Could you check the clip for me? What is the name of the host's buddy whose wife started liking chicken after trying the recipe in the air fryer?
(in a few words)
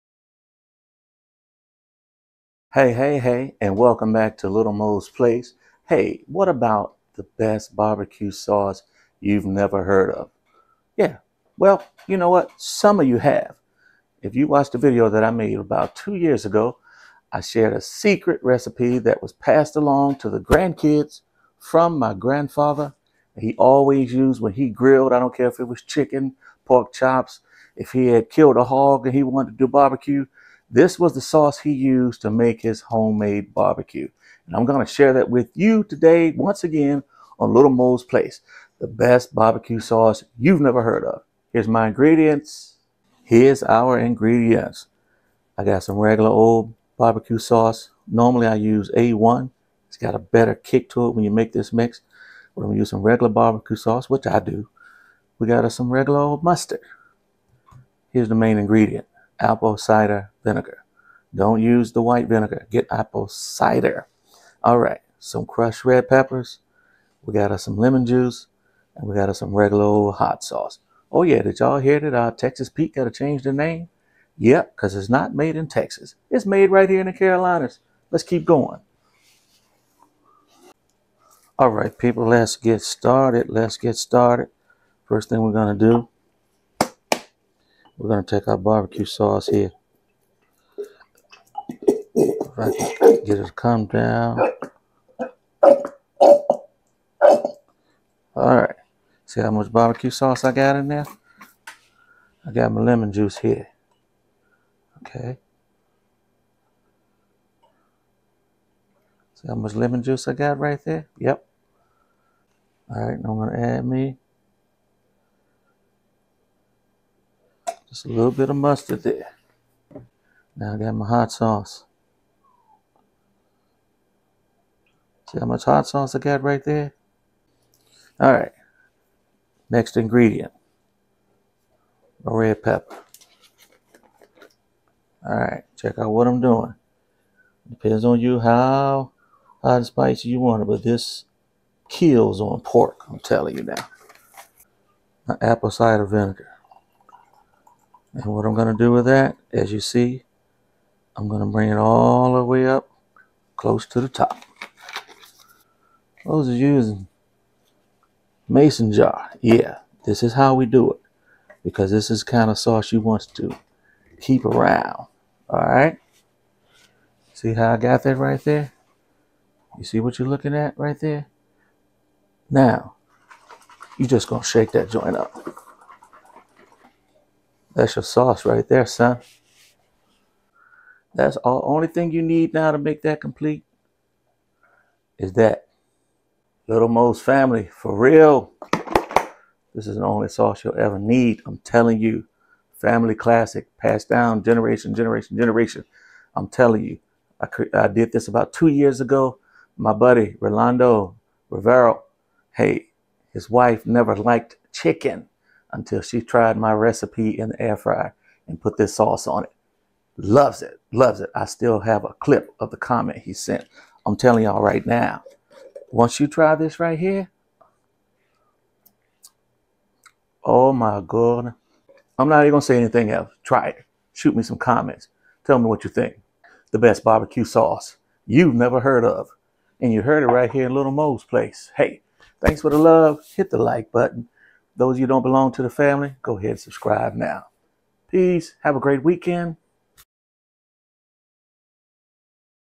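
Rolando Rivero.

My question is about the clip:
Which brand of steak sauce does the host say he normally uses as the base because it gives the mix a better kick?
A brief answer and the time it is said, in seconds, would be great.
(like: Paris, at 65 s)
A1, at 48 s.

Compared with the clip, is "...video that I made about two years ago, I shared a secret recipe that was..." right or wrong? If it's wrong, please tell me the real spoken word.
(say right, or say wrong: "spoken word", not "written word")
right.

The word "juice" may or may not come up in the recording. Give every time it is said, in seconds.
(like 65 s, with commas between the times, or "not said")
68 s, 103 s, 110 s.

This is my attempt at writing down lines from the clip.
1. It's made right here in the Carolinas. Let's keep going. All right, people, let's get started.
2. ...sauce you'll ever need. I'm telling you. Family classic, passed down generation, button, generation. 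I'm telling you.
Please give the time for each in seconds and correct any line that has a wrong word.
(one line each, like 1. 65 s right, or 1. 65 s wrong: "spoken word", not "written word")
1. 76 s right
2. 190 s wrong: "generation", not "button".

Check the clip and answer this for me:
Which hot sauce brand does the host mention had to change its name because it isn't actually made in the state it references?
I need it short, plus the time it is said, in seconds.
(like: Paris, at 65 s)
Texas Pete, at 72 s.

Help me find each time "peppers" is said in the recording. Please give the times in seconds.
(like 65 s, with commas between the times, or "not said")
66 s, 132 s.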